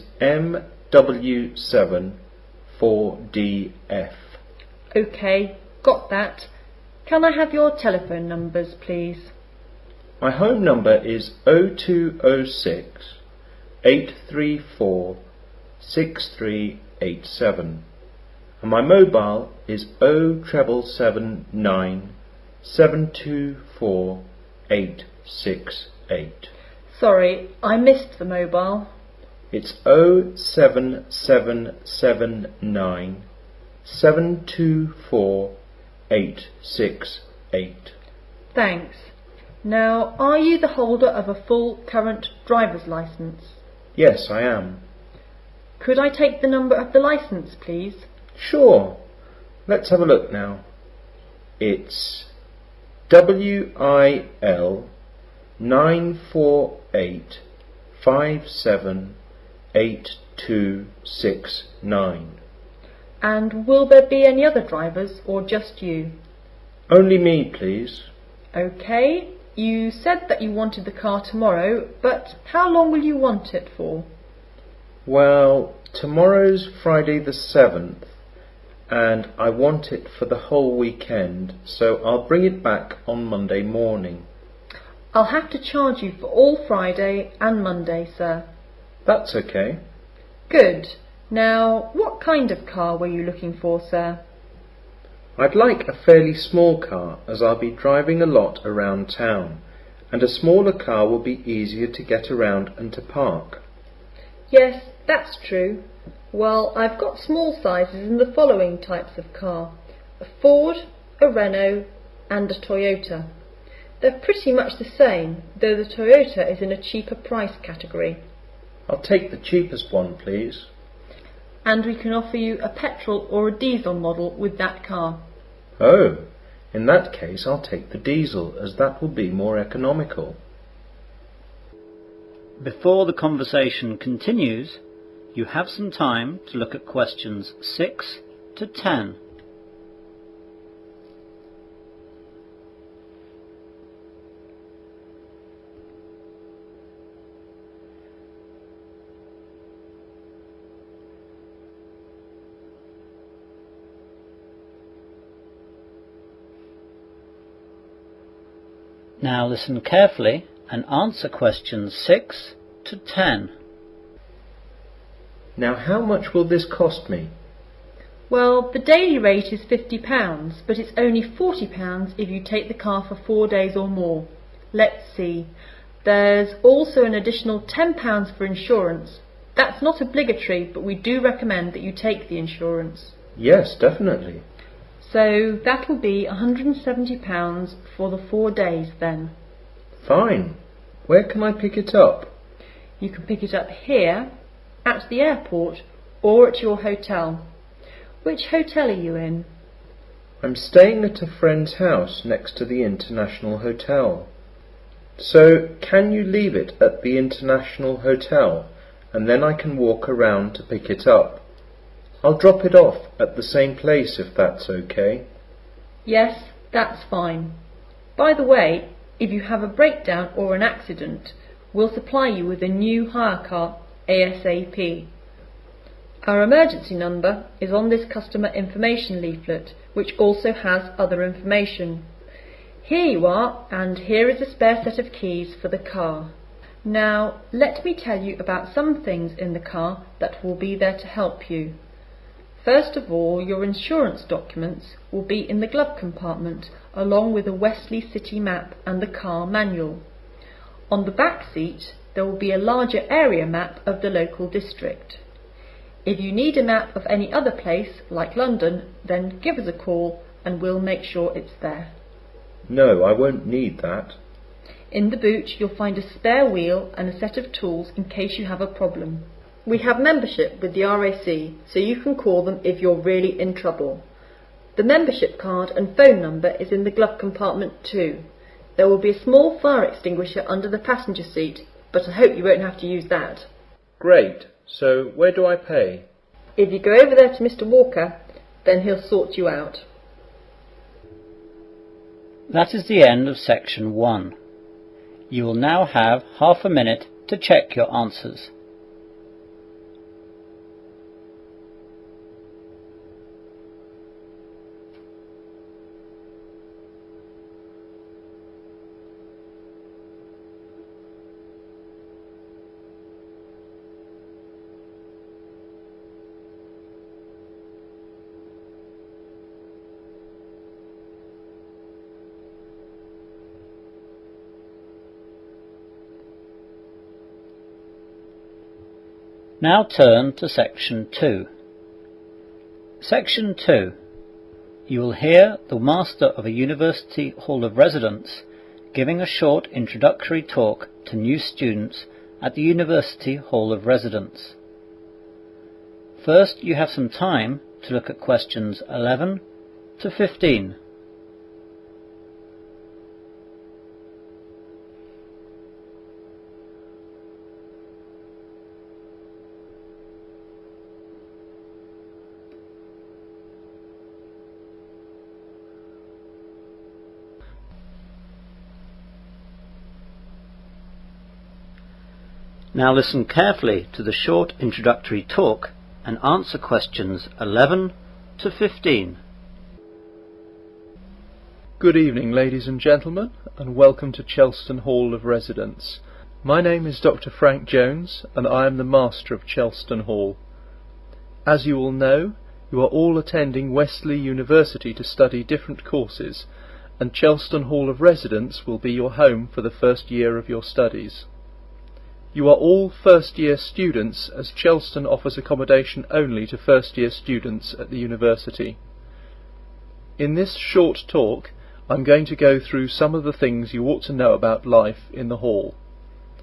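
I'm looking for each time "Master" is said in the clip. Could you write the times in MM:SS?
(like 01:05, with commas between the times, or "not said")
05:35, 06:28.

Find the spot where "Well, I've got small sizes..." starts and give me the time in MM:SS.
01:46.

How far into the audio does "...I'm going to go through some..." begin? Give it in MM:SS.
06:51.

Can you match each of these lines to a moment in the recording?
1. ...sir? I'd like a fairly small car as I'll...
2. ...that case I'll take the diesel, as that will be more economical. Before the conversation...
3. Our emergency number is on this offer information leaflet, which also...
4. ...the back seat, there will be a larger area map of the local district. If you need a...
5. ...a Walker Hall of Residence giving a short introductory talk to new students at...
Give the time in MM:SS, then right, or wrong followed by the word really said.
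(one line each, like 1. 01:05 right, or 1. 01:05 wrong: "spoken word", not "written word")
1. 01:33 right
2. 02:06 right
3. 03:46 wrong: "customer", not "offer"
4. 04:11 right
5. 05:36 wrong: "University", not "Walker".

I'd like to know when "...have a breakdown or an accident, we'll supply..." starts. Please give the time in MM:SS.
03:39.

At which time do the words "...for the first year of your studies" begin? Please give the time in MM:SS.
06:39.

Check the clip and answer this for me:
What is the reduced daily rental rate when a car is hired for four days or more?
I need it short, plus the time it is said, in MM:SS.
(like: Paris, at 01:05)
£40, at 02:51.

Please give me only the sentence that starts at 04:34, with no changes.
The membership card and phone number is in the glove compartment too.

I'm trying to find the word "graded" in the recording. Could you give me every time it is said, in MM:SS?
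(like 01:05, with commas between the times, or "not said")
not said.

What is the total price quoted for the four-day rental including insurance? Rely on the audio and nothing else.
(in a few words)
£170.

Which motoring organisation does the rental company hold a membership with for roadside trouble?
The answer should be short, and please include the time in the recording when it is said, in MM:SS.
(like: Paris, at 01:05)
RAC, at 04:30.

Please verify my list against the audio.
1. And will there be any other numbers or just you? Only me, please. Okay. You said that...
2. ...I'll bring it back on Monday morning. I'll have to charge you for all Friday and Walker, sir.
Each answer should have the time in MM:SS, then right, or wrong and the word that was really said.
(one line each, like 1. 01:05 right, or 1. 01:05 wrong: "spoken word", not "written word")
1. 01:03 wrong: "drivers", not "numbers"
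2. 01:22 wrong: "Monday", not "Walker".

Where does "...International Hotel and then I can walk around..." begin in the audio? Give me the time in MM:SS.
03:27.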